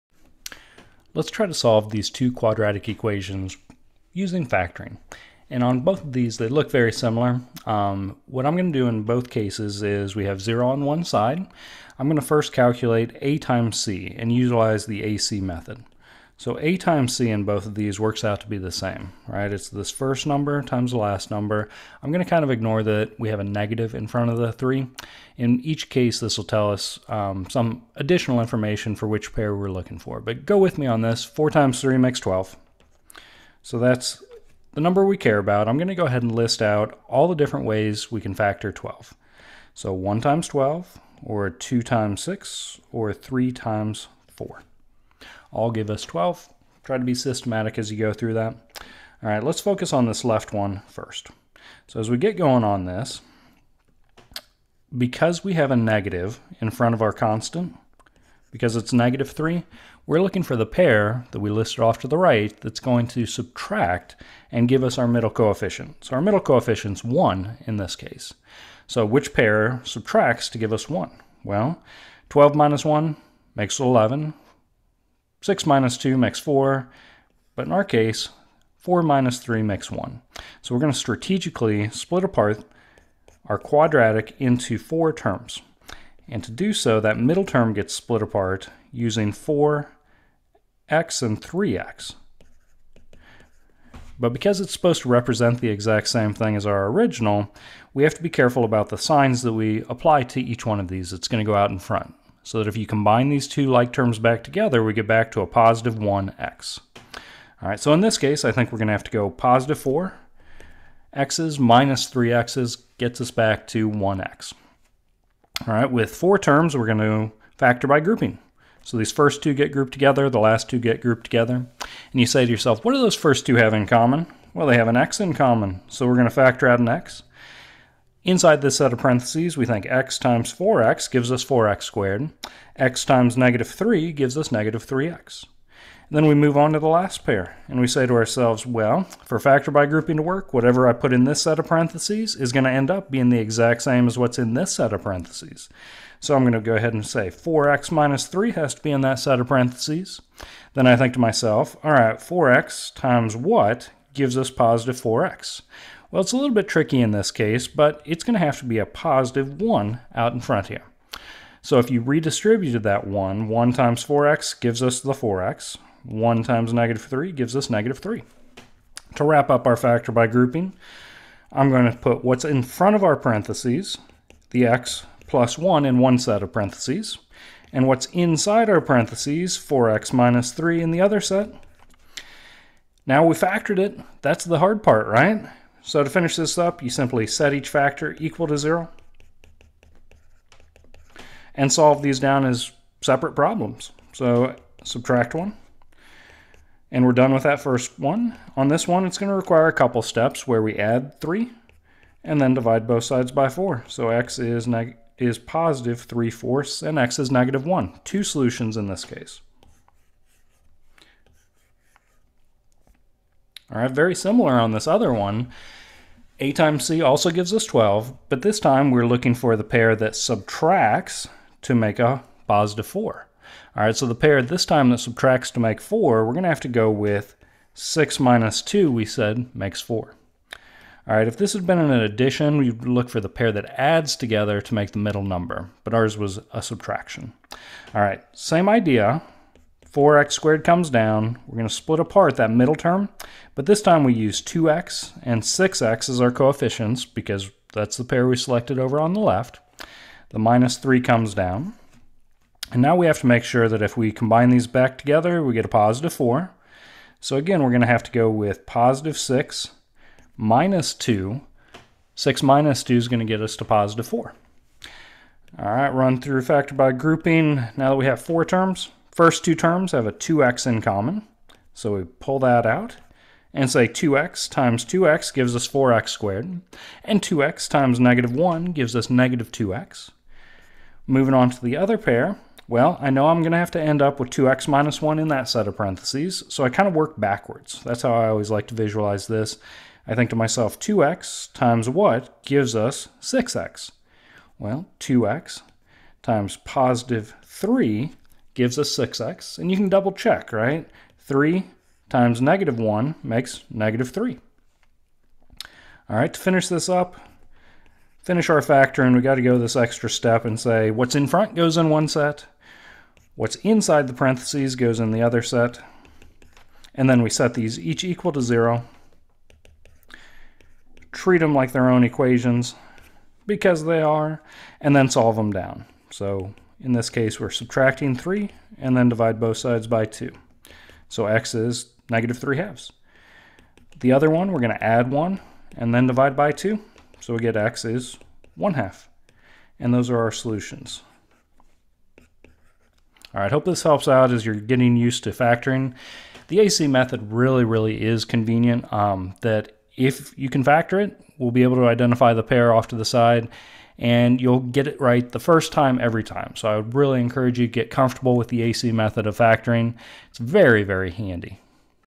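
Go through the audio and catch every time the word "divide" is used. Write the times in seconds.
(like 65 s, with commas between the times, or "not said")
202 s, 329 s, 336 s.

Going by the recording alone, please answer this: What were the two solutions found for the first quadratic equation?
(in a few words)
3/4 and -1.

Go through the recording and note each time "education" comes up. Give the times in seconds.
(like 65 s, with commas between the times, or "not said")
not said.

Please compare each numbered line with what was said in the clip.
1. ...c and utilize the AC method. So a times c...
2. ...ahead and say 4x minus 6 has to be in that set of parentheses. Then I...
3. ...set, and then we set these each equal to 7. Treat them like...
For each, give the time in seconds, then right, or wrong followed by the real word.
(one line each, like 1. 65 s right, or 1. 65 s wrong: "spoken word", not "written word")
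1. 13 s right
2. 146 s wrong: "3", not "6"
3. 315 s wrong: "0", not "7".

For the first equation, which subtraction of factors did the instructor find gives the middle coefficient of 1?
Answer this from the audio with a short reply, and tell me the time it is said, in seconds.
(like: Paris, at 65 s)
4 minus 3, at 78 s.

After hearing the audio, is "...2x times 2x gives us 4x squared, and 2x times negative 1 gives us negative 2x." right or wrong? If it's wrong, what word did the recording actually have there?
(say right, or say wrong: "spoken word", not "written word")
right.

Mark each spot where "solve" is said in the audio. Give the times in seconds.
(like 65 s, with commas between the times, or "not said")
1 s, 191 s, 325 s.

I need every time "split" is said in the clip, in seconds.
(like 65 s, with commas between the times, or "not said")
81 s, 87 s, 241 s.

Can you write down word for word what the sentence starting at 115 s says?
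All right, with four terms, we're going to factor by grouping.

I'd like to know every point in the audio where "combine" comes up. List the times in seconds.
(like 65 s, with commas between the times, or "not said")
102 s, 254 s.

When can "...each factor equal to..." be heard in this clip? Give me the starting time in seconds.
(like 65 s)
187 s.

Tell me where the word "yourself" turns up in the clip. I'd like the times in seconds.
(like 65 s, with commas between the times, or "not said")
122 s.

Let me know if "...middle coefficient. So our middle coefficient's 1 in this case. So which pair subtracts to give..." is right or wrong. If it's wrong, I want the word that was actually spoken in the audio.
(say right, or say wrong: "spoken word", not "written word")
right.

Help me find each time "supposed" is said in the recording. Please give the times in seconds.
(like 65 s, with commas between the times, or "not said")
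94 s.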